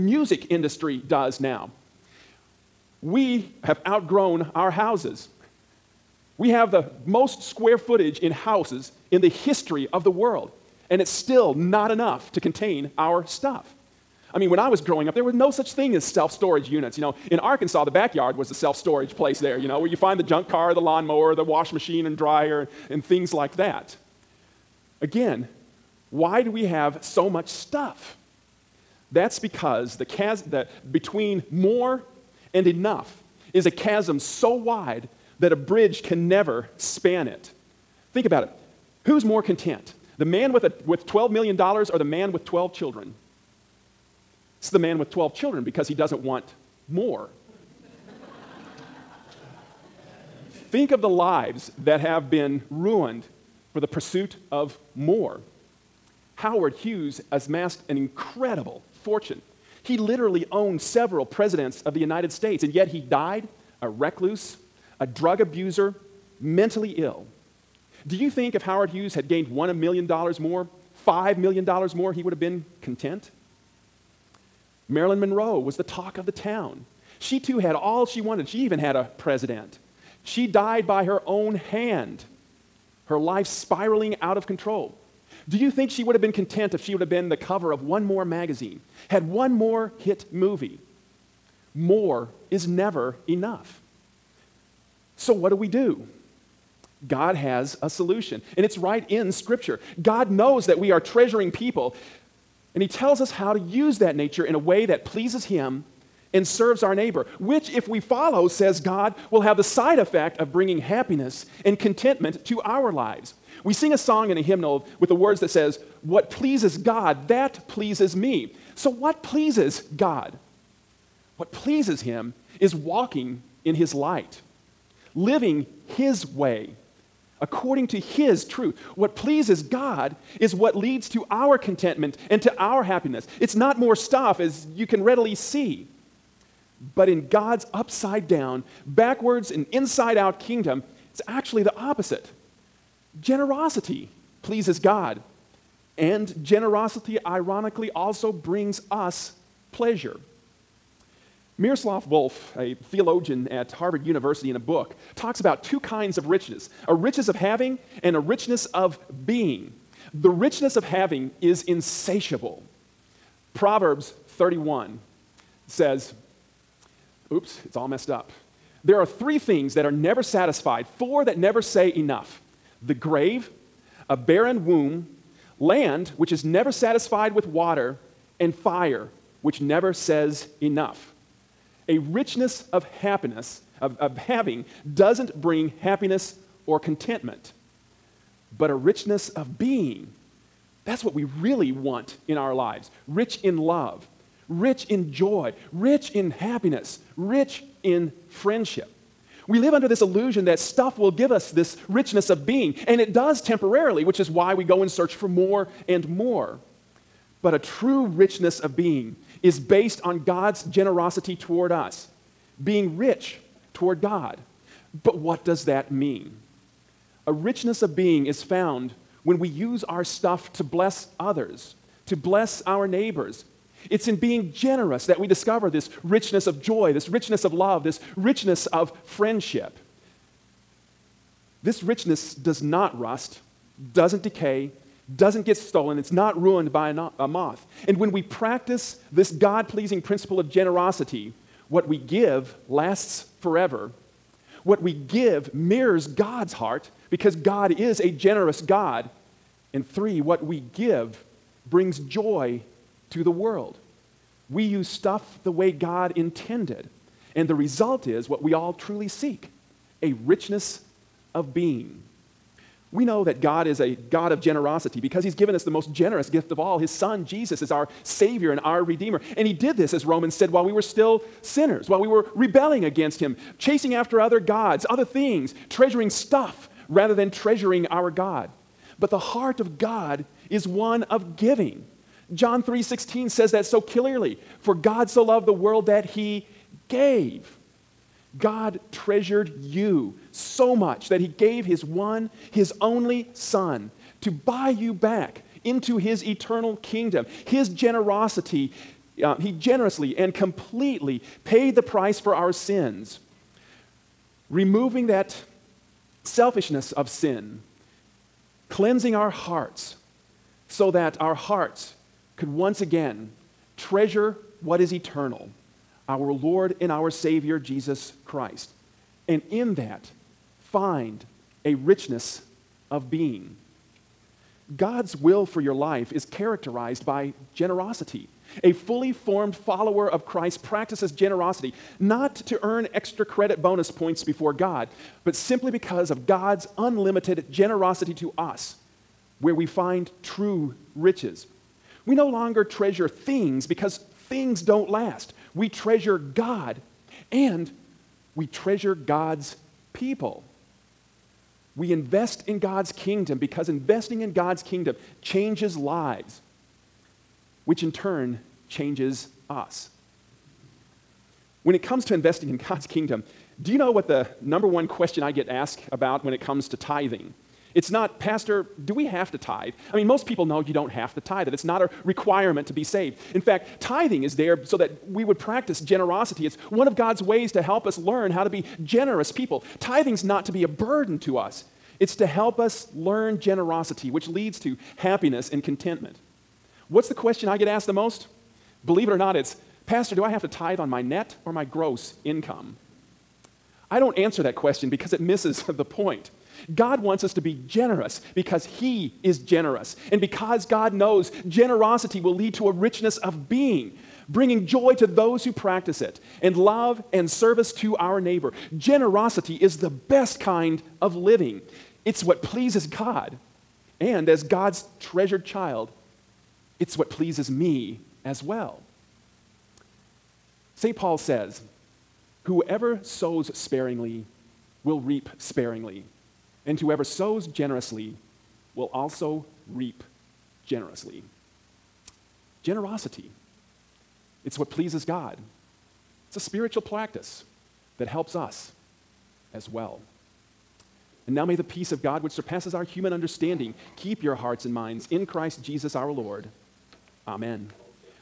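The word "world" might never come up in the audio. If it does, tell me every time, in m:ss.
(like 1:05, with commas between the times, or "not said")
0:10, 4:13, 4:45.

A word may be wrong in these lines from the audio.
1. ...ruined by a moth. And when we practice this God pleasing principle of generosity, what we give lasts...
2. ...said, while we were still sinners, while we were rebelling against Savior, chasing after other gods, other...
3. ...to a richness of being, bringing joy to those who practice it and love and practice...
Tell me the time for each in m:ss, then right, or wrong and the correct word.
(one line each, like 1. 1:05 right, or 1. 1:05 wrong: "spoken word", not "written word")
1. 3:56 right
2. 4:30 wrong: "Him", not "Savior"
3. 6:42 wrong: "service", not "practice".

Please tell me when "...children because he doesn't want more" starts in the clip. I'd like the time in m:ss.
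0:45.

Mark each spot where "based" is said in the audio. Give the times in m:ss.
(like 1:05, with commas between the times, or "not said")
3:29.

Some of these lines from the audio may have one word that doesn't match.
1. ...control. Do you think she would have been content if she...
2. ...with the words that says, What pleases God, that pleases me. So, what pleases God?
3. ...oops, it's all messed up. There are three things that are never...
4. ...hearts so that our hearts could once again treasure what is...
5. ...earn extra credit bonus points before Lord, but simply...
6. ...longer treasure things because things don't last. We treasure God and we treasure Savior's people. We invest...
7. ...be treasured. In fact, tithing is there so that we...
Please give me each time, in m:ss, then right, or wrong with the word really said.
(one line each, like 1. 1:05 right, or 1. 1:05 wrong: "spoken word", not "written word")
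1. 1:24 right
2. 1:54 right
3. 2:47 right
4. 5:09 right
5. 5:32 wrong: "God", not "Lord"
6. 5:42 wrong: "God", not "Savior"
7. 6:12 wrong: "saved", not "treasured".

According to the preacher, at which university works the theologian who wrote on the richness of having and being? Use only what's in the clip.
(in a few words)
Harvard University.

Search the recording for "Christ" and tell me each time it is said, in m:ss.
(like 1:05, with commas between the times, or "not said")
5:18, 5:30, 7:25.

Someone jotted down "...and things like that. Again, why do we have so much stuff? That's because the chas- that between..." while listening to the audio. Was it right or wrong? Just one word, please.
right.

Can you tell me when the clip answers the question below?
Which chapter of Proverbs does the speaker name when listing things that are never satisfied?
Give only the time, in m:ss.
2:43.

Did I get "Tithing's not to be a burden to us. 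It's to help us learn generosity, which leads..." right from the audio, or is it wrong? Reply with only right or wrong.
right.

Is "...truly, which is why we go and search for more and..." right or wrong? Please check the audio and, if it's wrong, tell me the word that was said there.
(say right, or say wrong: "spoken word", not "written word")
wrong: "temporarily", not "truly".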